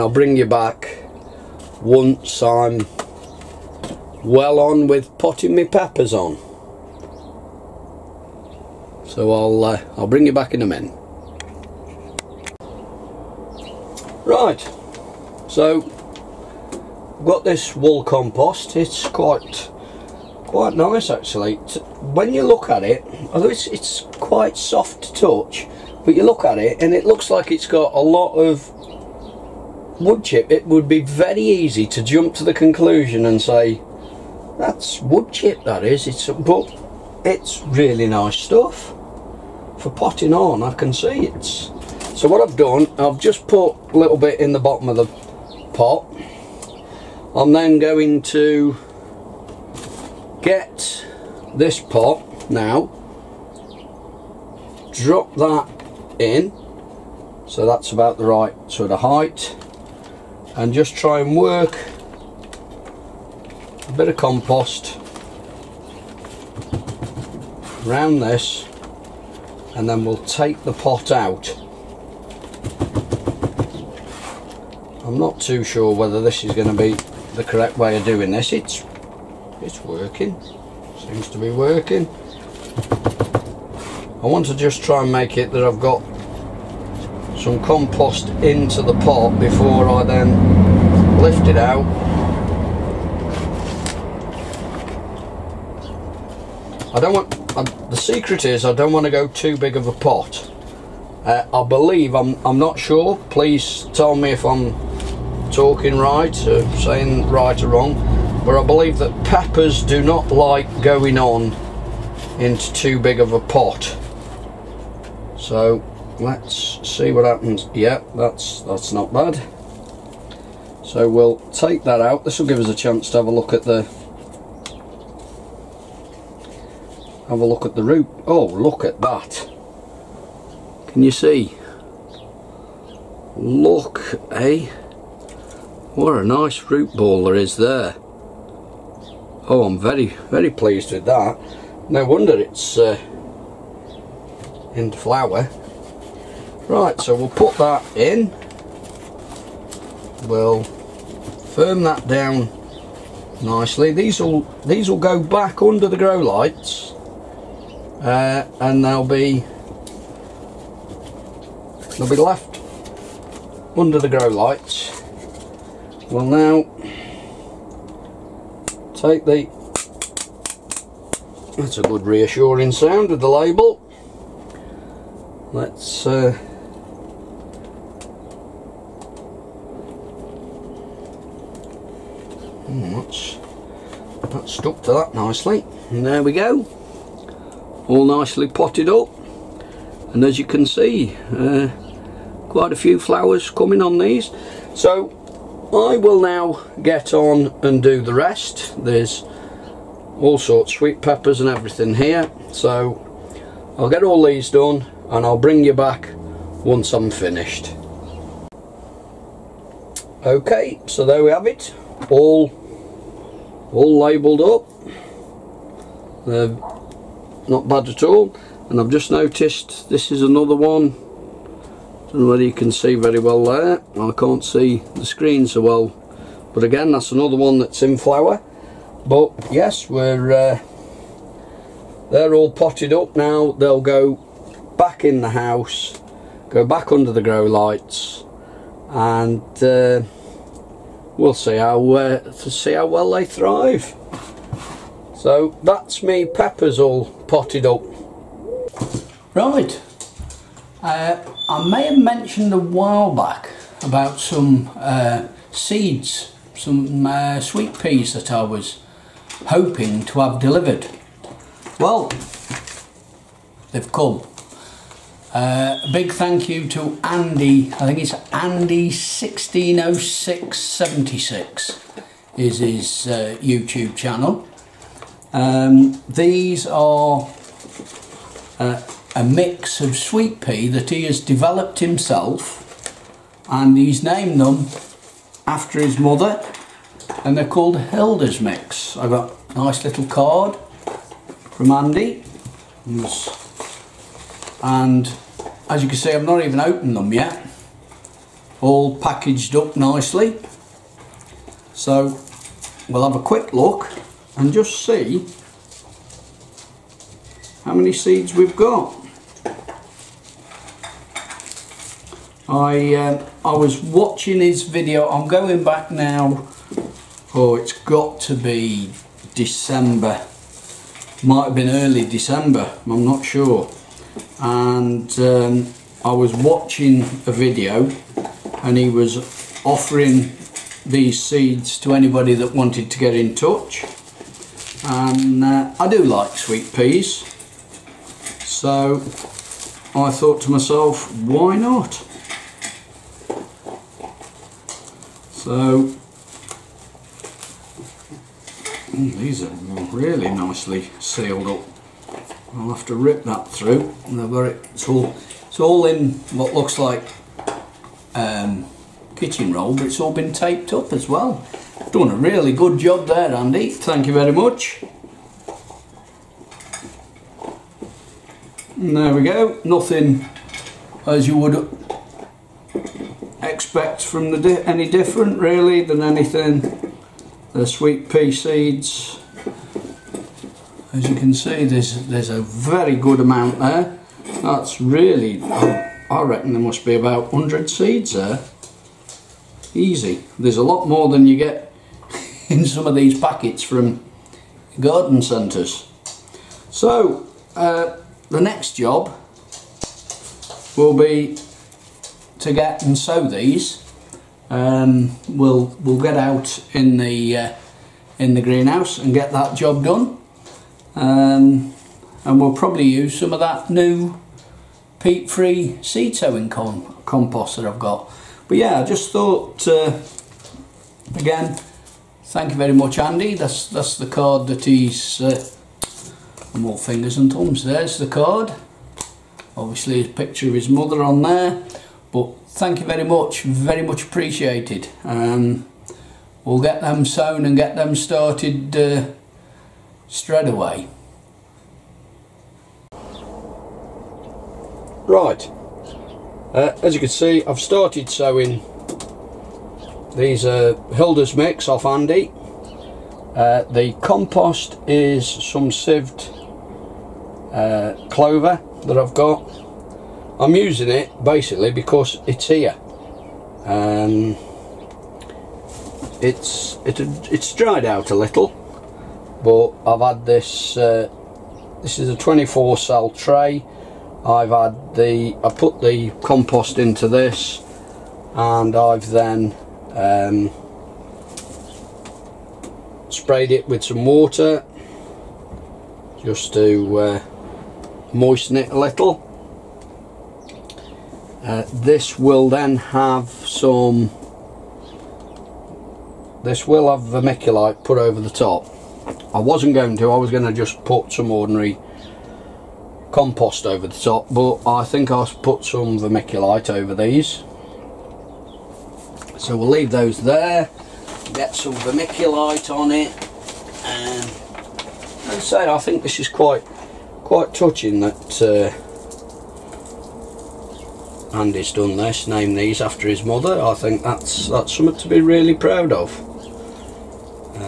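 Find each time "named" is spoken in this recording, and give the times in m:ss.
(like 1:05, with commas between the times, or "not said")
4:44, 8:42.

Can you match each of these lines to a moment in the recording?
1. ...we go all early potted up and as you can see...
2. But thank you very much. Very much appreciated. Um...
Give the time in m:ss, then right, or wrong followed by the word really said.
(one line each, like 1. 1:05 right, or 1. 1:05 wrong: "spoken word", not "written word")
1. 3:06 wrong: "nicely", not "early"
2. 7:12 right.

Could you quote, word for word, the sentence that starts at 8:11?
Uh, this will then have some, this will have vermiculite put over the top.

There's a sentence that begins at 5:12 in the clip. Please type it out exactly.
I um, I was watching his video.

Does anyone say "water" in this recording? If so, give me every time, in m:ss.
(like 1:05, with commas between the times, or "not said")
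8:04.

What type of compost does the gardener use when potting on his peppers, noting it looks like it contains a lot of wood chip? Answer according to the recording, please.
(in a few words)
Wool compost.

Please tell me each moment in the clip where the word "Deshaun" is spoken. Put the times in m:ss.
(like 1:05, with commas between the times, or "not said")
not said.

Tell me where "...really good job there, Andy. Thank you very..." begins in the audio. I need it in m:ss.
6:02.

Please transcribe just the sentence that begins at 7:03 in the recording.
That's that's the card that he's.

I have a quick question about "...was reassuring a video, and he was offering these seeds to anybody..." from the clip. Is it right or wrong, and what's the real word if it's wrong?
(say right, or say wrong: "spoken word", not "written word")
wrong: "watching", not "reassuring".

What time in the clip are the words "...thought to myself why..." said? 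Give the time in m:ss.
5:40.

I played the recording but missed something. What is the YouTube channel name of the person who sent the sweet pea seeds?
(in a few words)
Andy160676.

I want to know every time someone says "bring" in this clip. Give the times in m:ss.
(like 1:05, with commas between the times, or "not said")
0:00, 0:10, 3:25.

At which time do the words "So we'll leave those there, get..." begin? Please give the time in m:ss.
8:29.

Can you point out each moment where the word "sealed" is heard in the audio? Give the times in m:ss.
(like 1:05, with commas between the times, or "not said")
5:50.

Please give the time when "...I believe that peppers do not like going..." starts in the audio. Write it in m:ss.
1:48.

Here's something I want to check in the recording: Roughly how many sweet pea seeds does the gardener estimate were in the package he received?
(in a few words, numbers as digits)
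100.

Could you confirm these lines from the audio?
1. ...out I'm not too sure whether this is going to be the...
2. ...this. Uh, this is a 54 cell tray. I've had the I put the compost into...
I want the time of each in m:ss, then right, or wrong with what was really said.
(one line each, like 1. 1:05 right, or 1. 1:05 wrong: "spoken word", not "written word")
1. 1:11 right
2. 7:50 wrong: "24", not "54".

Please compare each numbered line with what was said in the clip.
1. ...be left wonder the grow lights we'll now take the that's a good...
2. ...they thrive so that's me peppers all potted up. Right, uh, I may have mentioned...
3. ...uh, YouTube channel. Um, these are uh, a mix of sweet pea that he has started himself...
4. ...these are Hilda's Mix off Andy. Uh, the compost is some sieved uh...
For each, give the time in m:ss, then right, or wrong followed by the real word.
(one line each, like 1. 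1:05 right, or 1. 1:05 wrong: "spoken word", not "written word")
1. 2:42 wrong: "under", not "wonder"
2. 4:03 right
3. 4:33 wrong: "developed", not "started"
4. 7:30 right.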